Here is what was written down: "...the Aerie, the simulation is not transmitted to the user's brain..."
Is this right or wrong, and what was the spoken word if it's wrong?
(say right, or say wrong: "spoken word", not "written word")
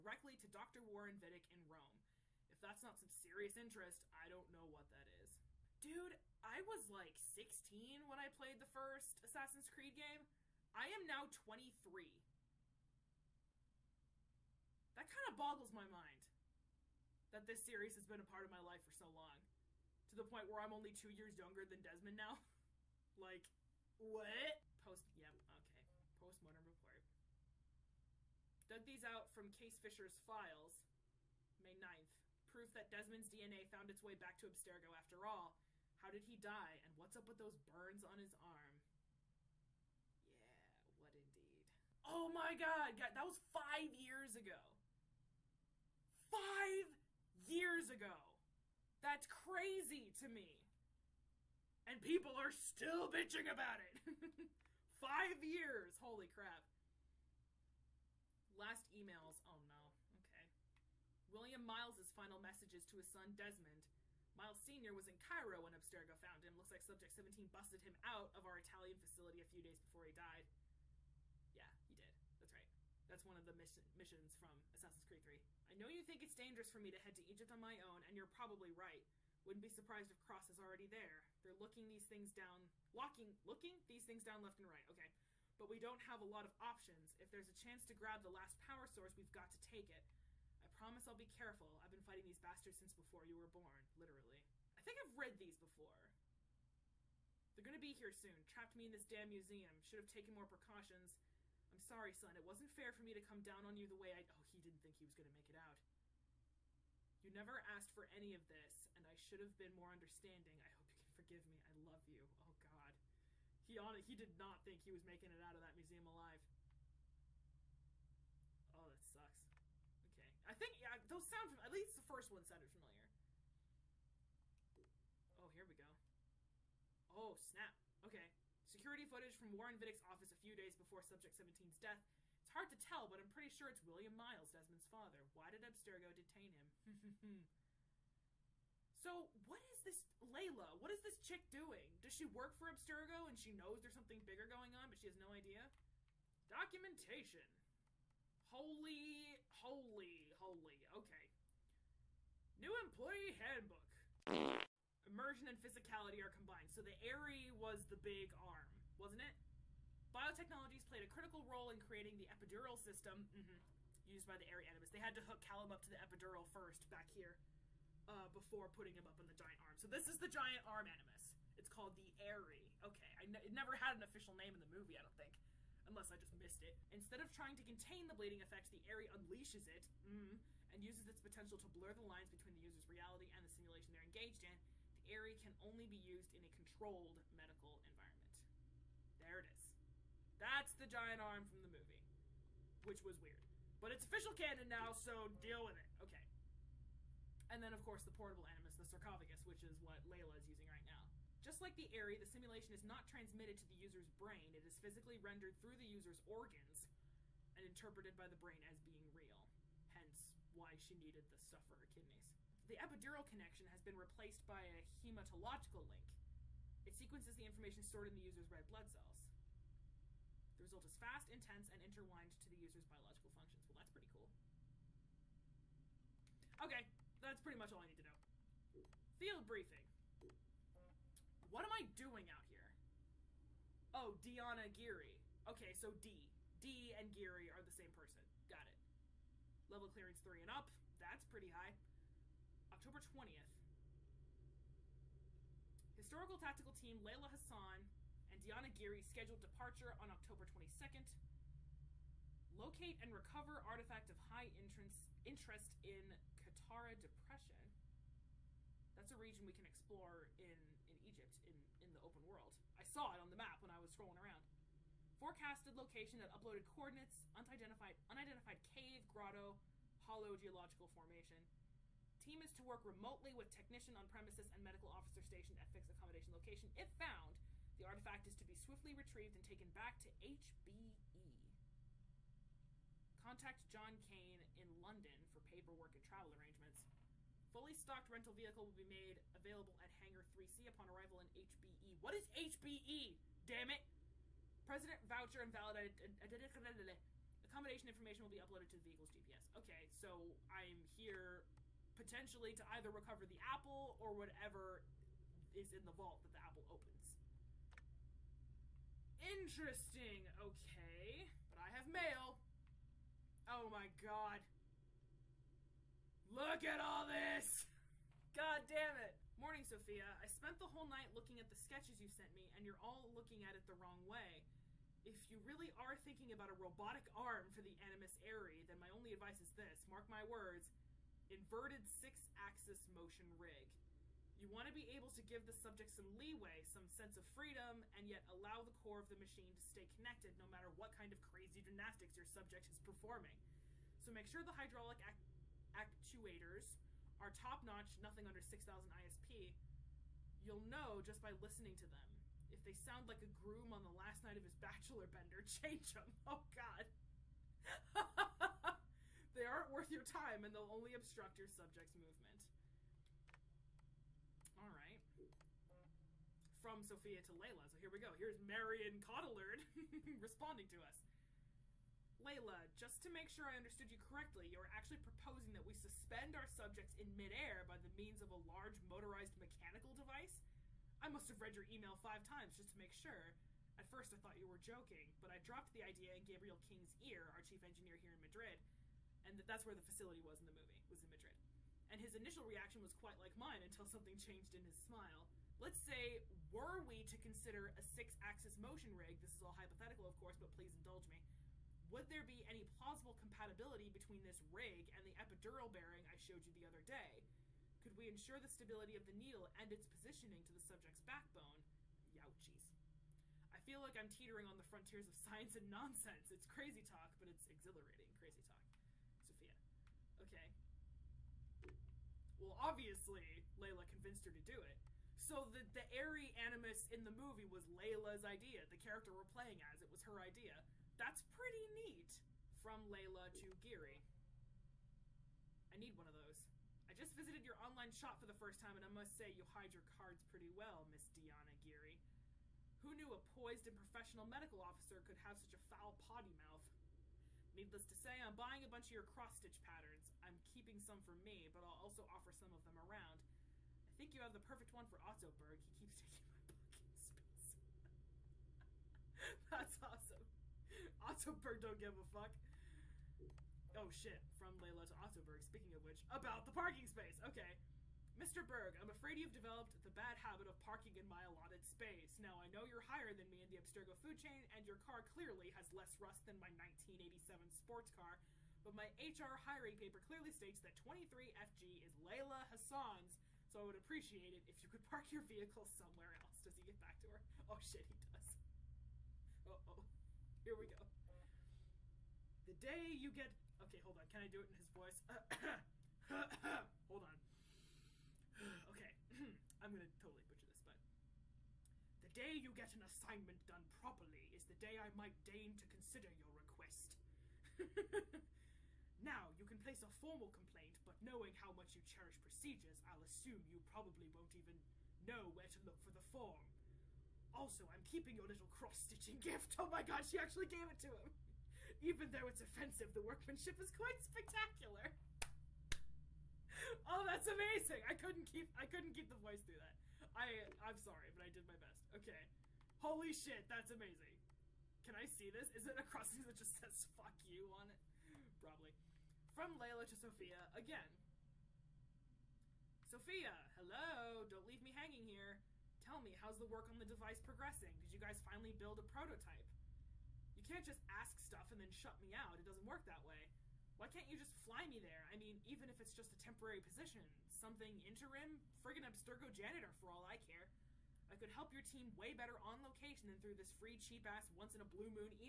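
right.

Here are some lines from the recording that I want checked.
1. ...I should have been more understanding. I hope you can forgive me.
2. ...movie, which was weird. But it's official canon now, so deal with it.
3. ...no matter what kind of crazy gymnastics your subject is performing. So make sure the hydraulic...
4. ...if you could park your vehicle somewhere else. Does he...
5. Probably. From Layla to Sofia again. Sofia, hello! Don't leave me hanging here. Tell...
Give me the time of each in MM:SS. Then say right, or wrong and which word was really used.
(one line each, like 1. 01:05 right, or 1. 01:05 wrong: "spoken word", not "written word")
1. 01:49 right
2. 03:11 right
3. 05:40 right
4. 08:04 right
5. 08:58 right.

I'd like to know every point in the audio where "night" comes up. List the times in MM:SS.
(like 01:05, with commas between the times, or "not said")
05:20, 05:54.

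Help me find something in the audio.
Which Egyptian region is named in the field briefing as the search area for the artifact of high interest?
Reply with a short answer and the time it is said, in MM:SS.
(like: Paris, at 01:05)
Qattara Depression, at 04:16.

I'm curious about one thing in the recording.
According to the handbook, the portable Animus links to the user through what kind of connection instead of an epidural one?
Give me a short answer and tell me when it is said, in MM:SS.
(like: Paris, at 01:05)
hematological link, at 03:34.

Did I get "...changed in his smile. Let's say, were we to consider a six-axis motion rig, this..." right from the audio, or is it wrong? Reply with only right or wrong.
right.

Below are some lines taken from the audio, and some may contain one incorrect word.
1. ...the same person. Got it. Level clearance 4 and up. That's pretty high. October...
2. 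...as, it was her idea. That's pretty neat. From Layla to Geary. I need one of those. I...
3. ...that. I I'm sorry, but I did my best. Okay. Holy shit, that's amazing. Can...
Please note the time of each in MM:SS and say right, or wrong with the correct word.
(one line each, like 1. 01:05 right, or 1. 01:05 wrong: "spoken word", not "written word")
1. 03:57 wrong: "3", not "4"
2. 07:09 right
3. 08:49 right.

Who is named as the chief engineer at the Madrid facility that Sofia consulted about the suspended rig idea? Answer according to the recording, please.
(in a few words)
Gabriel King.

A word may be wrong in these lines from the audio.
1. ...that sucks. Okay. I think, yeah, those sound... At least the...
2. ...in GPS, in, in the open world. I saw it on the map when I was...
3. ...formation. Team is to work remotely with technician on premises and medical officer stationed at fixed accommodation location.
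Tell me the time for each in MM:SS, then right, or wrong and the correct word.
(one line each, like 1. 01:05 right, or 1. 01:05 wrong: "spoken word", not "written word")
1. 01:58 right
2. 04:20 wrong: "Egypt", not "GPS"
3. 04:30 right.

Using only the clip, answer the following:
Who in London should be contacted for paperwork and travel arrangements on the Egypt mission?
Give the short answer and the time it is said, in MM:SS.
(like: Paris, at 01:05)
John Kane, at 04:43.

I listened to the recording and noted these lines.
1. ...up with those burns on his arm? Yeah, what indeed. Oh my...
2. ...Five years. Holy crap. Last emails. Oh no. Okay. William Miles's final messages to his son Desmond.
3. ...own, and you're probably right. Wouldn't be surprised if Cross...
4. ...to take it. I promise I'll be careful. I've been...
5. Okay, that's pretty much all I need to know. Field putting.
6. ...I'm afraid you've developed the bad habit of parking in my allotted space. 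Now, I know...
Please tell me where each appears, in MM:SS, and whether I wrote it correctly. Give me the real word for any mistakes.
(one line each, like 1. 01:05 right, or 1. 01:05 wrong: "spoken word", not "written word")
1. 00:37 right
2. 00:54 right
3. 01:17 right
4. 01:29 right
5. 03:46 wrong: "briefing", not "putting"
6. 07:48 right.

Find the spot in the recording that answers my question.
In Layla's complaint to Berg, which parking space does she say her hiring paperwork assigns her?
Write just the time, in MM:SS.
08:00.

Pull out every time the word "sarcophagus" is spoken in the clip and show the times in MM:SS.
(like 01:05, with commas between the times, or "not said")
03:18.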